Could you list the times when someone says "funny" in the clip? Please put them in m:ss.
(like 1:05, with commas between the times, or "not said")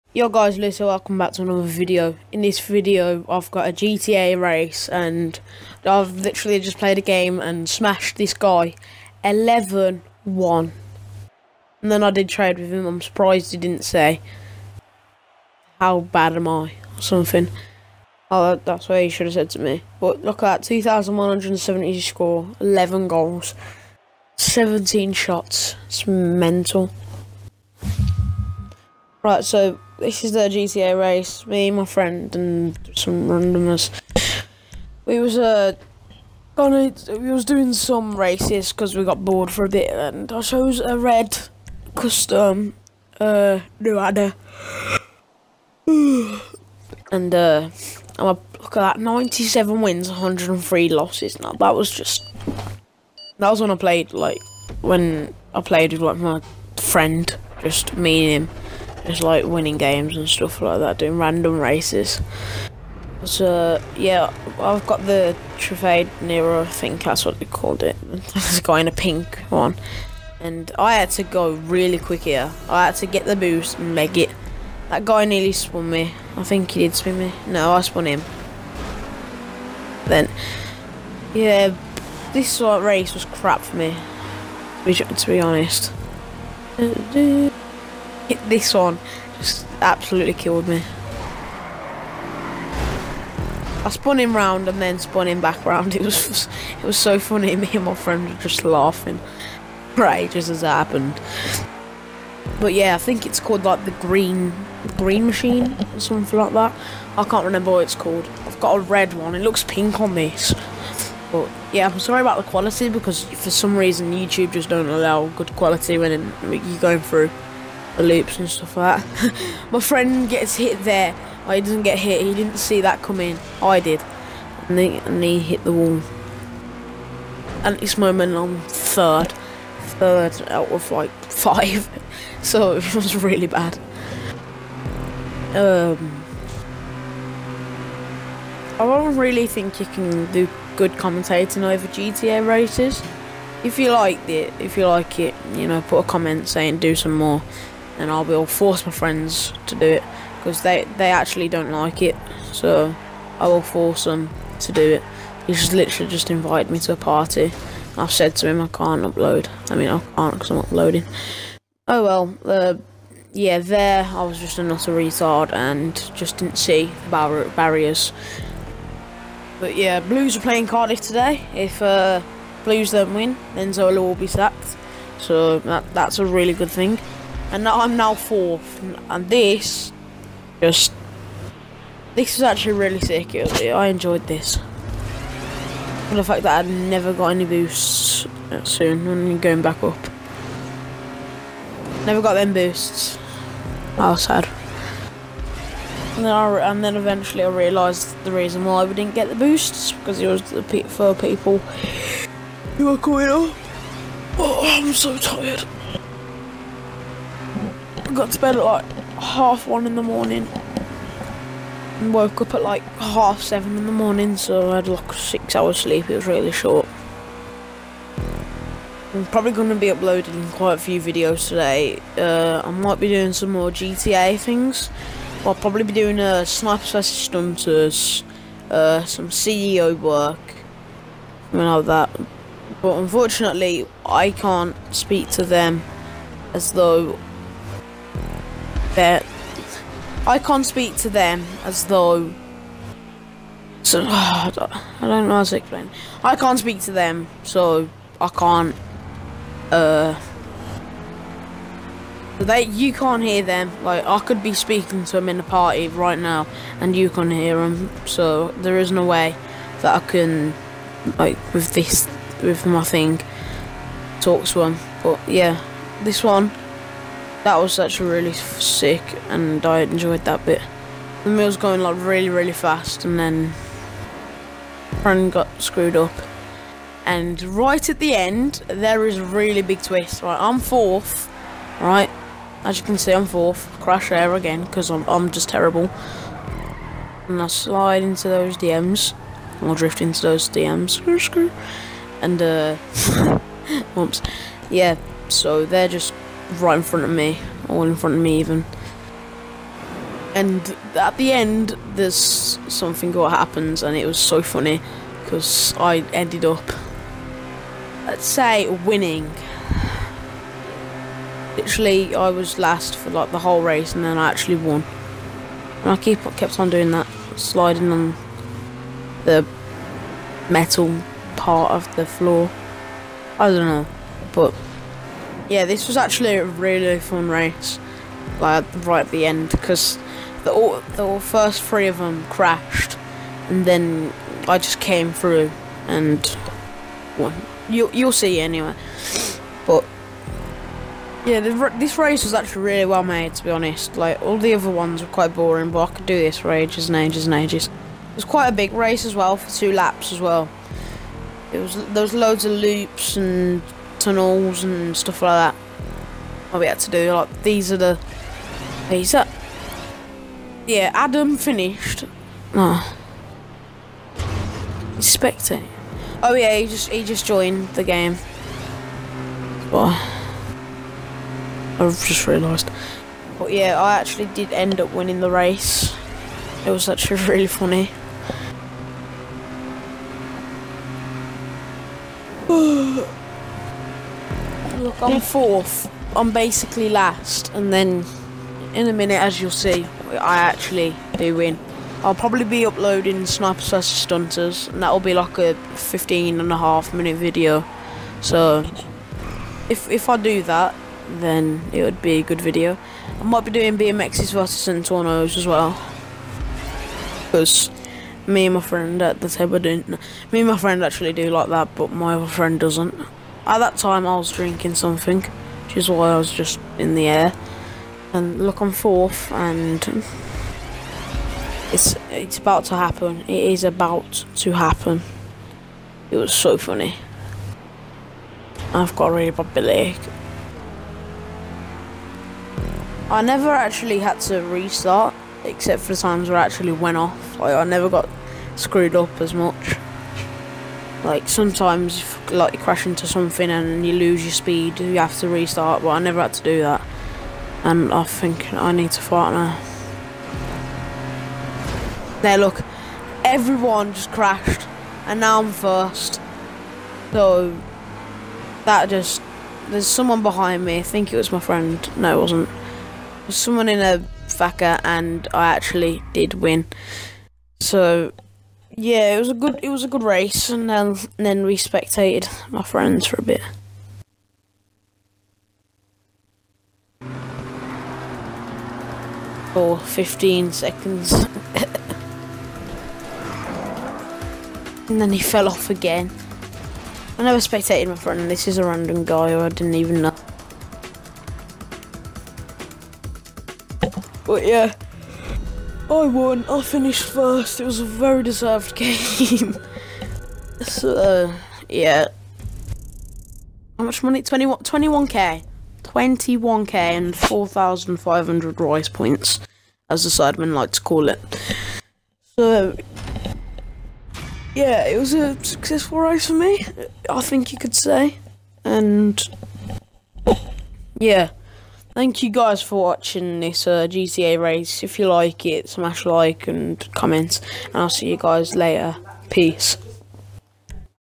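1:37, 5:04, 6:17, 7:06.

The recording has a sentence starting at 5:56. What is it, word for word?
What we had to do, like, these are the...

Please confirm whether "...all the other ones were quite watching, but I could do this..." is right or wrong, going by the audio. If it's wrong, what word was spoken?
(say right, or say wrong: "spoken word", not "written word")
wrong: "boring", not "watching".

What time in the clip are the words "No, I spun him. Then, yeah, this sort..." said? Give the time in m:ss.
1:17.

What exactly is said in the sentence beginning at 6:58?
And look, I'm fourth, and it's it's about to happen.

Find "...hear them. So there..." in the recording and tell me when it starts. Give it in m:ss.
4:17.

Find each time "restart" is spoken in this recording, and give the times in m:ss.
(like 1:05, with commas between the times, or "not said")
7:14, 7:25.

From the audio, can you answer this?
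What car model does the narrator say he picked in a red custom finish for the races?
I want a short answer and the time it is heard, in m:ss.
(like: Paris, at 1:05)
Nuada, at 0:43.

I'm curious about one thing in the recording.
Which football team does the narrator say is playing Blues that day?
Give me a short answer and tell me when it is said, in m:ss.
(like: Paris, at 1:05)
Cardiff, at 2:50.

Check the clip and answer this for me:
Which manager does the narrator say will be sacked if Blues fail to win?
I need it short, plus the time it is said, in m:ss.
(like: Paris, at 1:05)
Zola, at 2:53.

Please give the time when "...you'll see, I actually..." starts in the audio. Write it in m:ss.
6:29.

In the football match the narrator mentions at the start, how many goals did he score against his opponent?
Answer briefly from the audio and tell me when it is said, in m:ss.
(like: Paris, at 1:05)
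11, at 0:22.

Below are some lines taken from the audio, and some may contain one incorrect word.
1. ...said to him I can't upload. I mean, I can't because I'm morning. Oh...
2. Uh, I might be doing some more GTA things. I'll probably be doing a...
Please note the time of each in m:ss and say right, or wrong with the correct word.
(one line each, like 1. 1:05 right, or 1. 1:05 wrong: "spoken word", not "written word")
1. 2:38 wrong: "uploading", not "morning"
2. 3:42 right.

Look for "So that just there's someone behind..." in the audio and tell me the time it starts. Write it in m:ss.
7:37.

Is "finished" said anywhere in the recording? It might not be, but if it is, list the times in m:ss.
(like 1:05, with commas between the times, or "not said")
6:01, 8:16.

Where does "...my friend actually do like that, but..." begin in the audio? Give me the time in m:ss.
6:50.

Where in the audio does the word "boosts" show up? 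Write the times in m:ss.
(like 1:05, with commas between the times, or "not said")
1:13, 3:07, 3:12, 3:19.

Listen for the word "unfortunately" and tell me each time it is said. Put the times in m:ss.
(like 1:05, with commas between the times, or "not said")
3:52.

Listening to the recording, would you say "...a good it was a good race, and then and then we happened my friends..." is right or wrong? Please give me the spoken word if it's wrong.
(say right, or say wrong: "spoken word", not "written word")
wrong: "spectated", not "happened".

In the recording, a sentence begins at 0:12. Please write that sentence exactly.
I'm surprised he didn't say, how bad am I or something.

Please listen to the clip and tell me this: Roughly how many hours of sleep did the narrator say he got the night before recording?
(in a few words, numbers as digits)
6.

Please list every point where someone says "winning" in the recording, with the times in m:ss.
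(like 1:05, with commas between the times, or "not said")
0:59, 5:08, 6:14.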